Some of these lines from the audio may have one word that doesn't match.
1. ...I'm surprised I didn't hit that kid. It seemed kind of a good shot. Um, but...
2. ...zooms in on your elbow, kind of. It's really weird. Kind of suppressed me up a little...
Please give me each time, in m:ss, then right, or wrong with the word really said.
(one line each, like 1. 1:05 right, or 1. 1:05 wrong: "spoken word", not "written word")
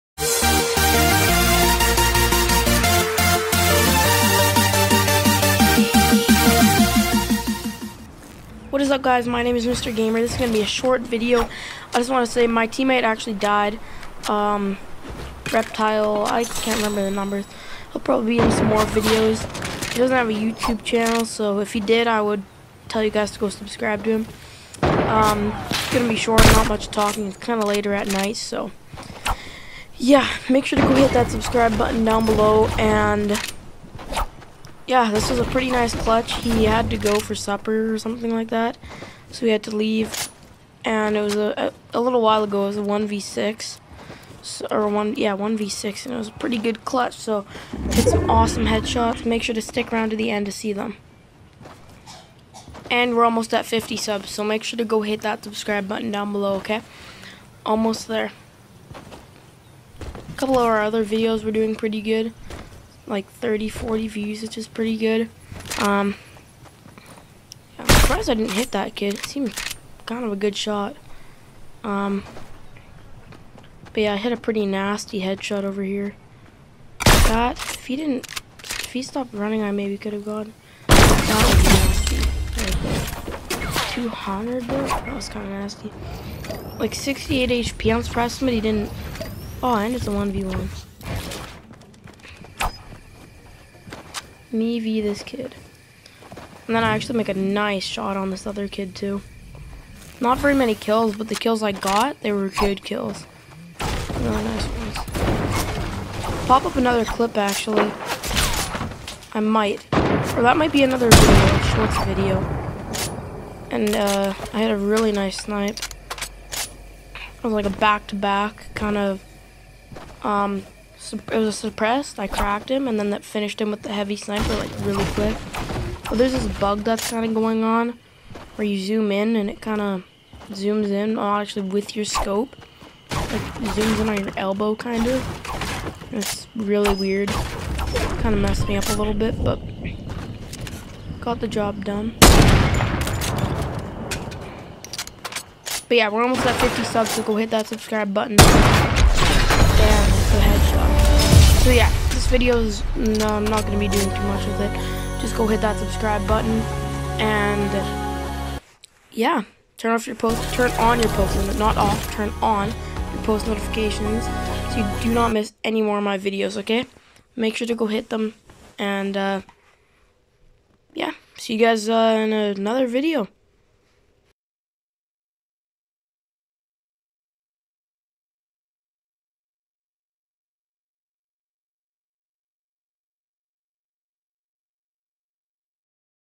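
1. 1:07 right
2. 2:13 wrong: "messed", not "suppressed".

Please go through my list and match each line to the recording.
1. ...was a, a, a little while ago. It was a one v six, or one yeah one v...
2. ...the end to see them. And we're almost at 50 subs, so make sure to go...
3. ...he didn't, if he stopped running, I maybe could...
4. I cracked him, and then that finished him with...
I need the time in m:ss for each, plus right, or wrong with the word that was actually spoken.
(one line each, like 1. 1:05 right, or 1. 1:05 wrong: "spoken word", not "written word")
1. 0:41 right
2. 0:50 right
3. 1:17 right
4. 2:02 right.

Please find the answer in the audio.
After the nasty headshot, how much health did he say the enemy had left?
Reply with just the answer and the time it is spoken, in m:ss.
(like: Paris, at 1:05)
68 HP, at 1:26.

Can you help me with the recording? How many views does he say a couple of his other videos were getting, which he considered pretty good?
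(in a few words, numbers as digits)
30, 40.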